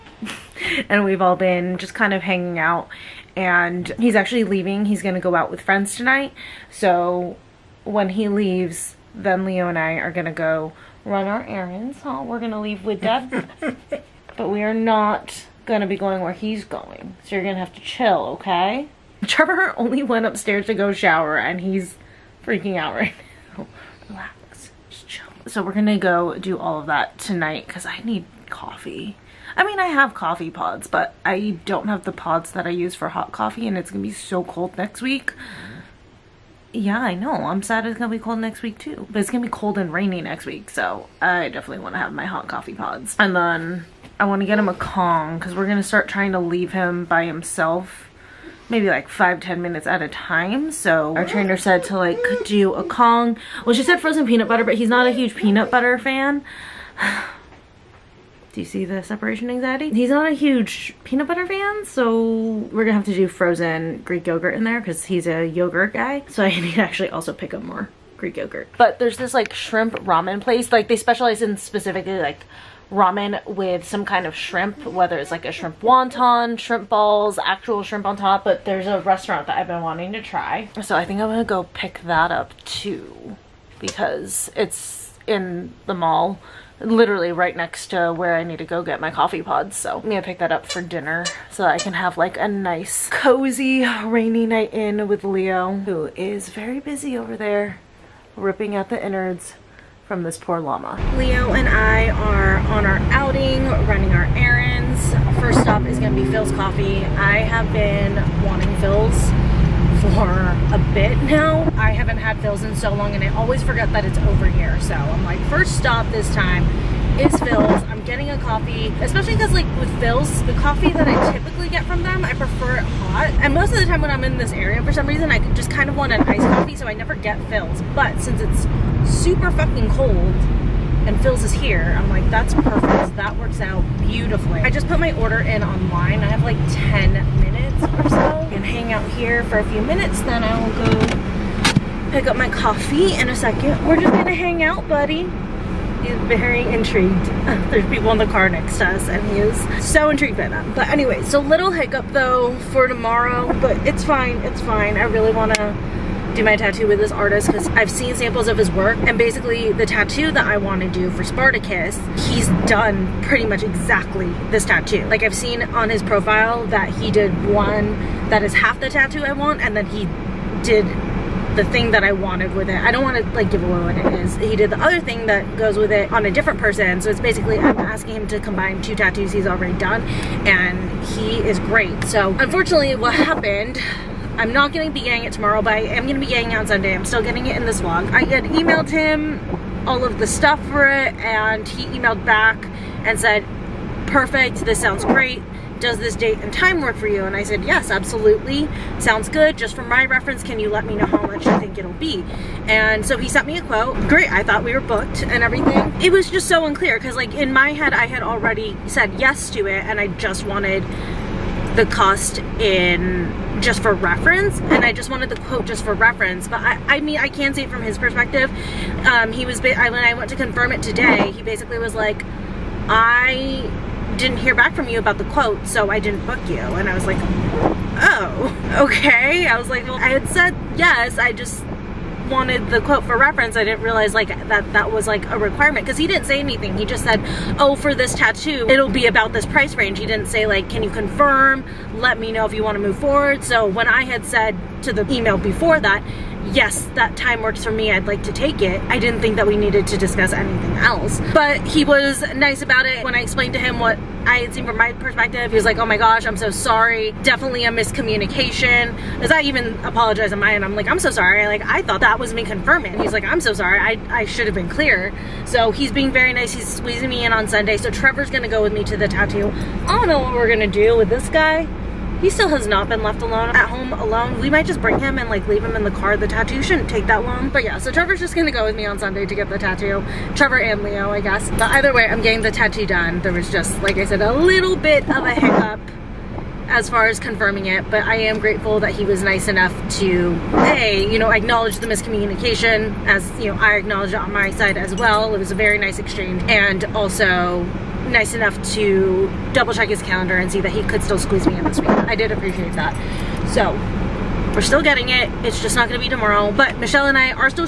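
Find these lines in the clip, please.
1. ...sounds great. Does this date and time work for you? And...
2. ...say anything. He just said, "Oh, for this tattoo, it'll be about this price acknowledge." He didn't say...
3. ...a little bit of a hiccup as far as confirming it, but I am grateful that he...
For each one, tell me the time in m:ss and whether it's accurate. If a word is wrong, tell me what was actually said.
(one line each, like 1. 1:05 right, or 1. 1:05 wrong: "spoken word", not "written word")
1. 3:14 right
2. 3:56 wrong: "range", not "acknowledge"
3. 4:44 right.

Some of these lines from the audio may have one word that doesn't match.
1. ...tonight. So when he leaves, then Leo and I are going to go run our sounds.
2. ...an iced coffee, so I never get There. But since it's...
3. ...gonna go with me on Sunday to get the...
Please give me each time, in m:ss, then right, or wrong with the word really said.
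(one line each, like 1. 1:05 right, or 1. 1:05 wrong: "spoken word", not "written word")
1. 0:05 wrong: "errands", not "sounds"
2. 2:06 wrong: "Philz", not "There"
3. 4:38 right.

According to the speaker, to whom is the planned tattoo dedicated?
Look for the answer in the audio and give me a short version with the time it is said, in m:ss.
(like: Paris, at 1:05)
Spartacus, at 2:41.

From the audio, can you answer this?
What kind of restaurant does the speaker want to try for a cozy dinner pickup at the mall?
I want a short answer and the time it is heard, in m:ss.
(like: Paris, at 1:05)
shrimp ramen, at 1:09.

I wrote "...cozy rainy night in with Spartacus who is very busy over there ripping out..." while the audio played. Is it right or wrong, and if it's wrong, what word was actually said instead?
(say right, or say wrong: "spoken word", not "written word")
wrong: "Leo", not "Spartacus".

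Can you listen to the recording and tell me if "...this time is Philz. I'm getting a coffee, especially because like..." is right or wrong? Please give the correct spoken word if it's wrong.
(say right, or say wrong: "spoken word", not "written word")
right.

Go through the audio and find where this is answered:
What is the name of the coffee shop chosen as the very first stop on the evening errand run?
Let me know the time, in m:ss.
1:46.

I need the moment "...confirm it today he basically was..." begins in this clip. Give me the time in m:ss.
3:40.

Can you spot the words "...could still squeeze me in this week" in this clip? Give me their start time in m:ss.
5:00.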